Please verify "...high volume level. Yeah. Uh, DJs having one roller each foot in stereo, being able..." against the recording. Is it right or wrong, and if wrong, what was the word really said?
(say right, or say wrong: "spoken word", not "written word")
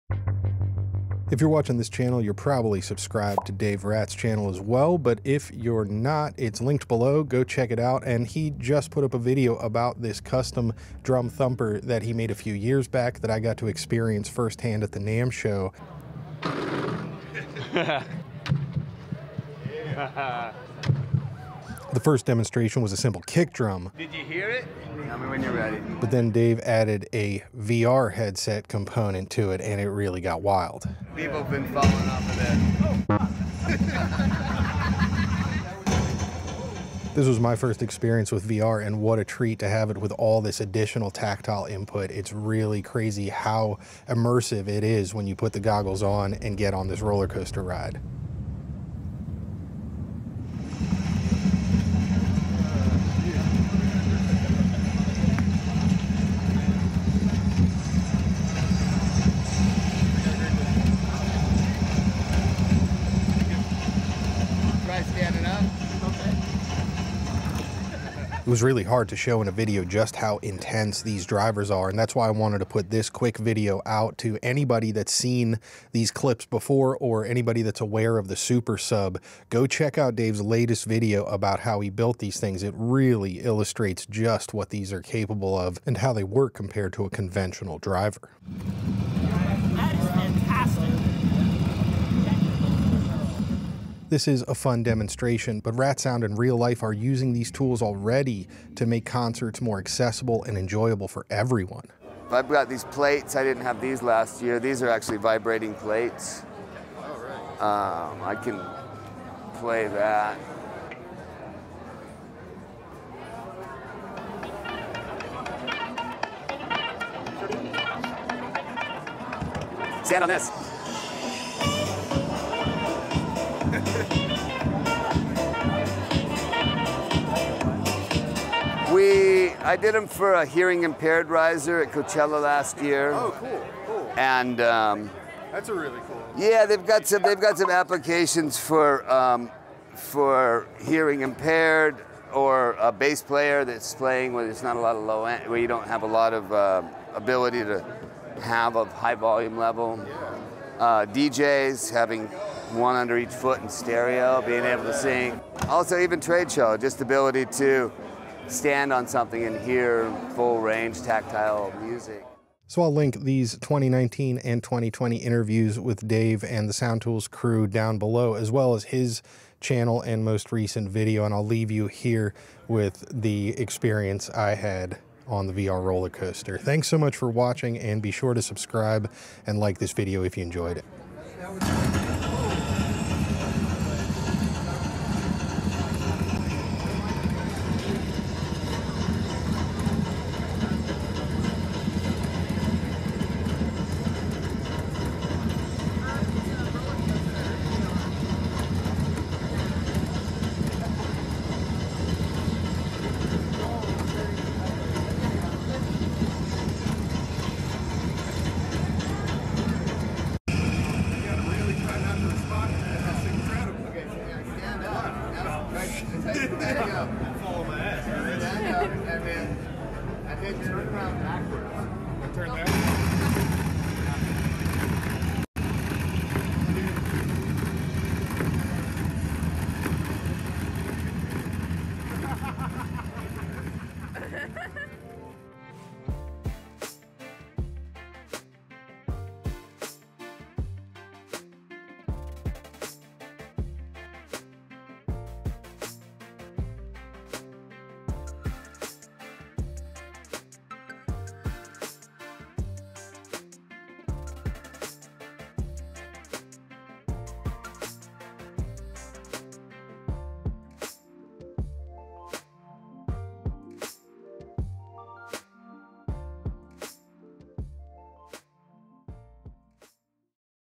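wrong: "under", not "roller".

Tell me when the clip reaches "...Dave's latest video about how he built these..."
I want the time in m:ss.
1:20.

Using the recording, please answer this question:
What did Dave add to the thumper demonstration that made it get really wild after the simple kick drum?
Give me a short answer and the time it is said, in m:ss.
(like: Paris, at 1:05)
VR headset, at 0:27.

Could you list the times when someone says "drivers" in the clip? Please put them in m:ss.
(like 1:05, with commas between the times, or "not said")
1:11, 1:27.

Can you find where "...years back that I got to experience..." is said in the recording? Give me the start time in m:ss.
0:12.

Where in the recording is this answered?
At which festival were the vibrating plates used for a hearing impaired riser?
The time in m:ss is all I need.
2:11.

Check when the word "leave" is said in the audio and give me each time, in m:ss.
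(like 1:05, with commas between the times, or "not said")
2:51.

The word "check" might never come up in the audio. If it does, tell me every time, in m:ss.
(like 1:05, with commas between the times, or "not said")
0:07, 1:19.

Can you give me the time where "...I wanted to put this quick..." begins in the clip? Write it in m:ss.
1:12.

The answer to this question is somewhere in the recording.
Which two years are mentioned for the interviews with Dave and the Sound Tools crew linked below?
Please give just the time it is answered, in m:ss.
2:43.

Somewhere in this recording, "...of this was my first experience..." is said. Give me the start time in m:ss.
0:33.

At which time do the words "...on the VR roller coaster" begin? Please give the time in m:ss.
2:55.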